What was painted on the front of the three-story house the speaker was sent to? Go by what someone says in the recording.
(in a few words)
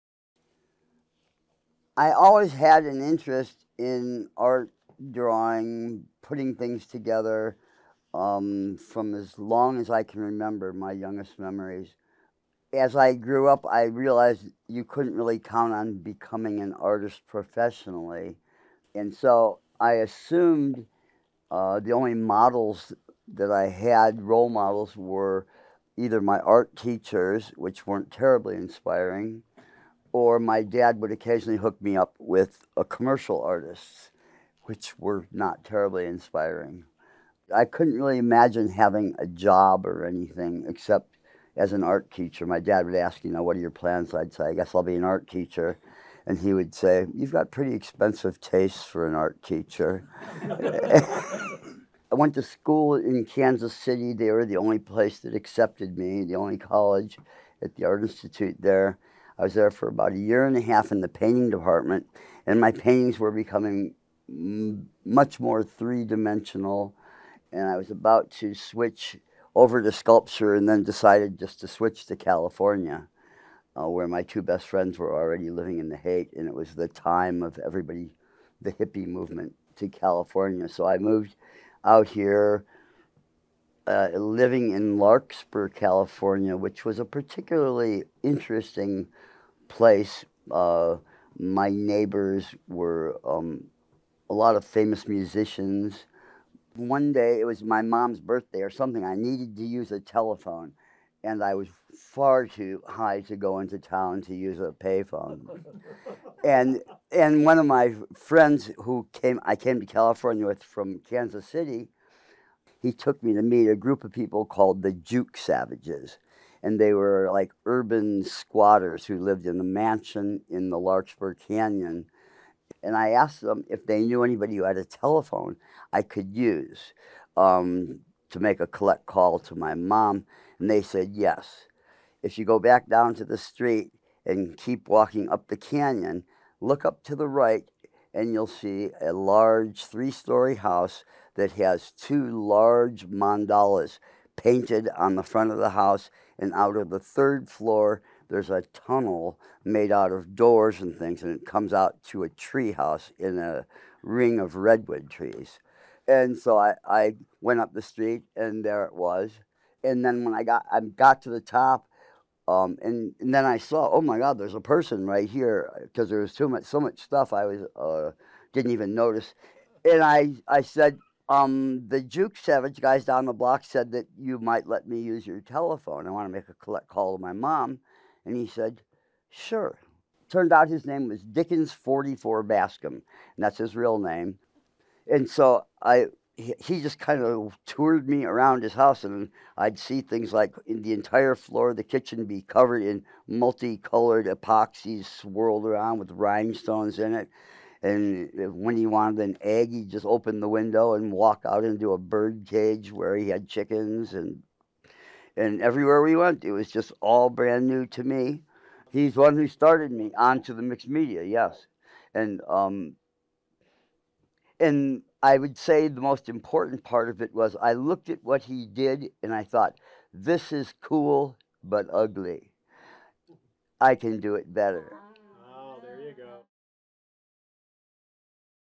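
Two large mandalas.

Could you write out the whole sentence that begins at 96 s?
One day, it was my mom's birthday or something.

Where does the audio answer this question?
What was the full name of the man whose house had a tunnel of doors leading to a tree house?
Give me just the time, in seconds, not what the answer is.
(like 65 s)
181 s.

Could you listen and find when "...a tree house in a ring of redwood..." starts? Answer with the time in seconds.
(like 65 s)
152 s.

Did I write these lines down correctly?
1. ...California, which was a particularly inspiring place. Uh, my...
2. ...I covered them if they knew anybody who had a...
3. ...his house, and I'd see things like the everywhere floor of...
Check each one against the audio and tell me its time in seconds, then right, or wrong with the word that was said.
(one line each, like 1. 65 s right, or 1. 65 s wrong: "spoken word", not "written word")
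1. 85 s wrong: "interesting", not "inspiring"
2. 122 s wrong: "asked", not "covered"
3. 188 s wrong: "entire", not "everywhere".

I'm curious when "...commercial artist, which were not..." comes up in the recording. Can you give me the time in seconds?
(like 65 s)
32 s.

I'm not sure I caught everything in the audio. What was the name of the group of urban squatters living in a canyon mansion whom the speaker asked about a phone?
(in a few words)
Jook Savages.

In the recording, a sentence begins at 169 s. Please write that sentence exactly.
And I I said, um, the Jook Savage guys down the block said that you might let me use your telephone.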